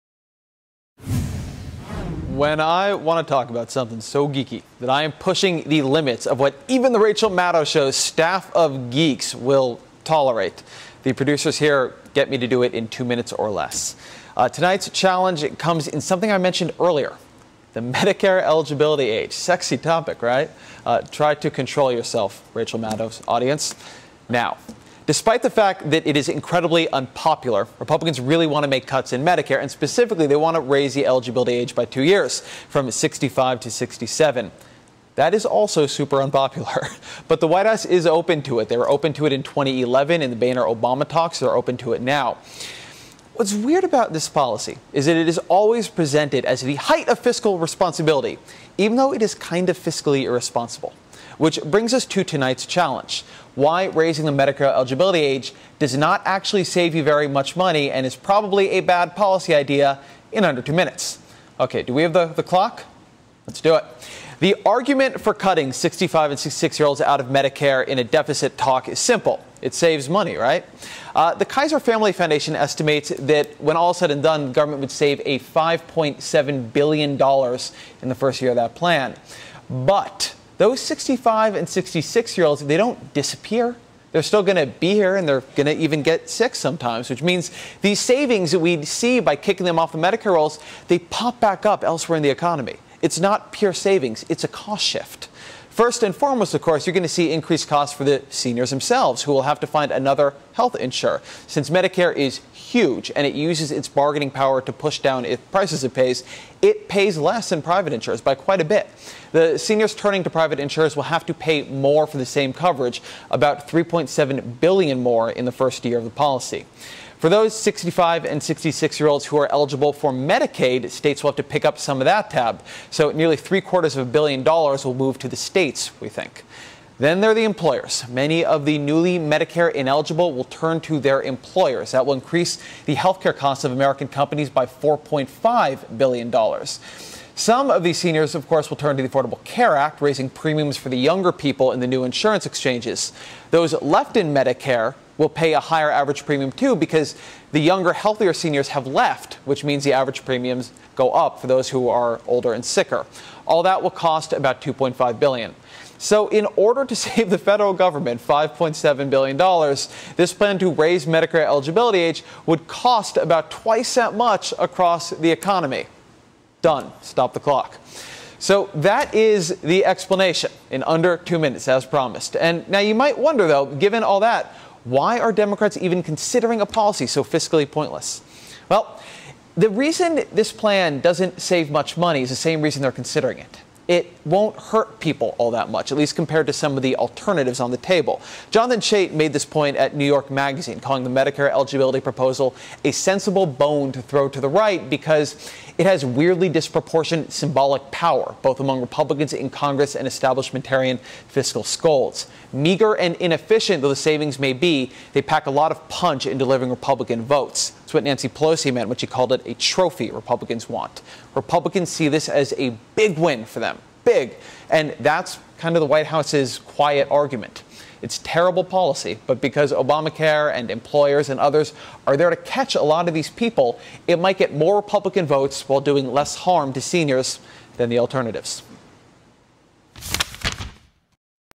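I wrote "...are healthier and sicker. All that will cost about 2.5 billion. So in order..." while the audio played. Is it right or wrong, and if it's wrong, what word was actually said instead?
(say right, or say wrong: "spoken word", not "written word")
wrong: "older", not "healthier".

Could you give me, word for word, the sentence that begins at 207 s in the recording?
That's what Nancy Pelosi meant when she called it a trophy Republicans want.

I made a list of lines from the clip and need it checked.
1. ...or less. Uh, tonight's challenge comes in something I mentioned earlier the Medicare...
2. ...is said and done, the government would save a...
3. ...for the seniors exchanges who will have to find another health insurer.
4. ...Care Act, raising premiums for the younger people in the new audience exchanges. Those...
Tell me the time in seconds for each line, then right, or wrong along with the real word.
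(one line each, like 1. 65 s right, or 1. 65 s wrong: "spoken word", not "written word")
1. 13 s right
2. 73 s right
3. 97 s wrong: "themselves", not "exchanges"
4. 139 s wrong: "insurance", not "audience".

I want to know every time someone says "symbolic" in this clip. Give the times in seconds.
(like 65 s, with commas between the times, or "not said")
197 s.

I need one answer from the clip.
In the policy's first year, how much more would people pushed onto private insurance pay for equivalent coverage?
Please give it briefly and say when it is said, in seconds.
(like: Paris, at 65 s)
3.7 billion, at 113 s.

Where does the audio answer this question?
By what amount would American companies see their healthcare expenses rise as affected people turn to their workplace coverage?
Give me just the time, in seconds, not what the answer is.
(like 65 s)
134 s.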